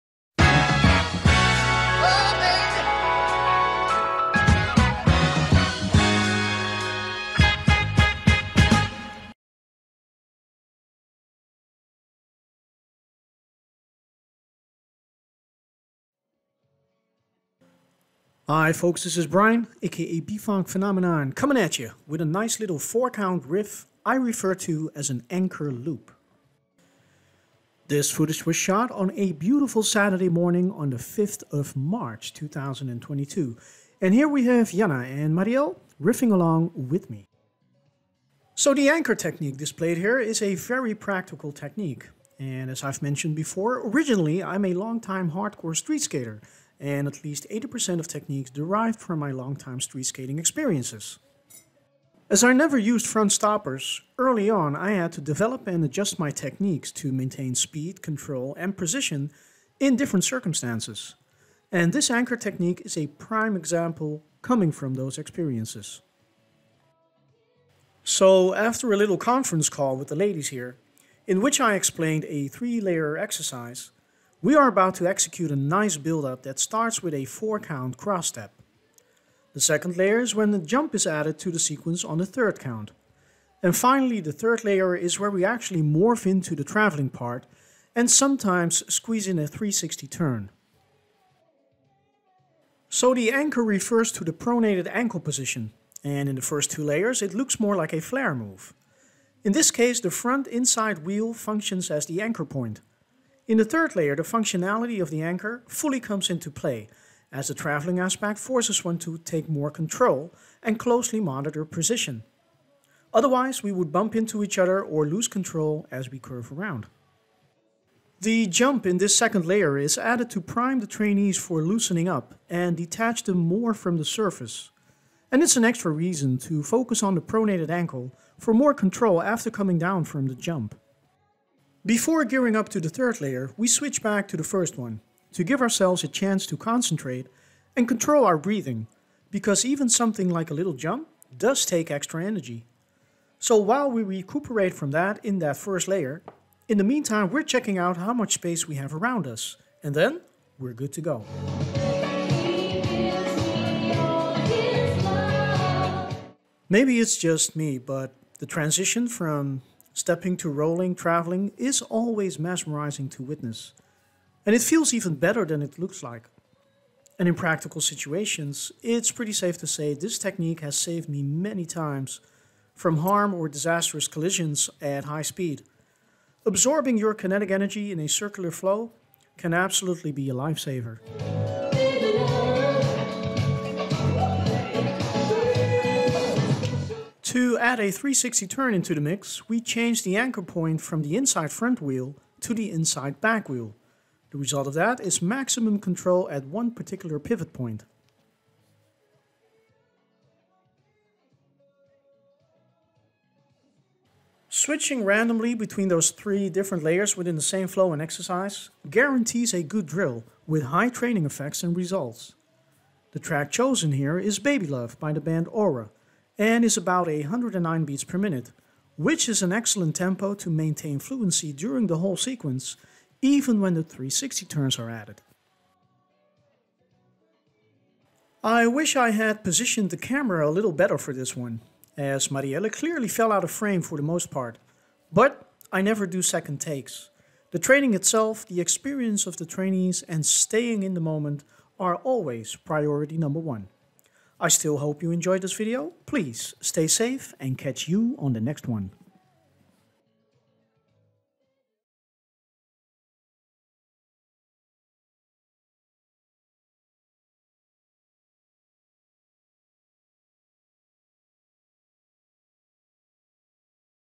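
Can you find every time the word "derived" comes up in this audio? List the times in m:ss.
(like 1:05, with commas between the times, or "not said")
0:48.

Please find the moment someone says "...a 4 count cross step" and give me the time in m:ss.
1:17.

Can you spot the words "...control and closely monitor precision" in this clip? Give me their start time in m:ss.
1:49.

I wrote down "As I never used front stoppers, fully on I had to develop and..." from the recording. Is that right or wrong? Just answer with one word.
wrong.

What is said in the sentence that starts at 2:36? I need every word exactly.
Maybe it's just me, but the transition from Stepping to rolling, traveling is always mesmerizing to witness.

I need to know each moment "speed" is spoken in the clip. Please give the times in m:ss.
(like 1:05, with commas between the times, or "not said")
0:57, 2:55.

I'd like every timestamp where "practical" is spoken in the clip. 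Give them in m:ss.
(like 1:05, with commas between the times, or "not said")
0:40, 2:47.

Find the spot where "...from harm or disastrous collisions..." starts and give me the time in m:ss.
2:52.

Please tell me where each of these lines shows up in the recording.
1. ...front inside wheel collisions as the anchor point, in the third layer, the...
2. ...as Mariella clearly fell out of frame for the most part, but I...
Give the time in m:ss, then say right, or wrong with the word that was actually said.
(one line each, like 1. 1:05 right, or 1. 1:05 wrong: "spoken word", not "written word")
1. 1:40 wrong: "functions", not "collisions"
2. 3:51 right.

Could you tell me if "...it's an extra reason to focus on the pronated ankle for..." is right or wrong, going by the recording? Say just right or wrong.
right.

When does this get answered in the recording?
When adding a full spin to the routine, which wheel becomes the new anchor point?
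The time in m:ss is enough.
3:12.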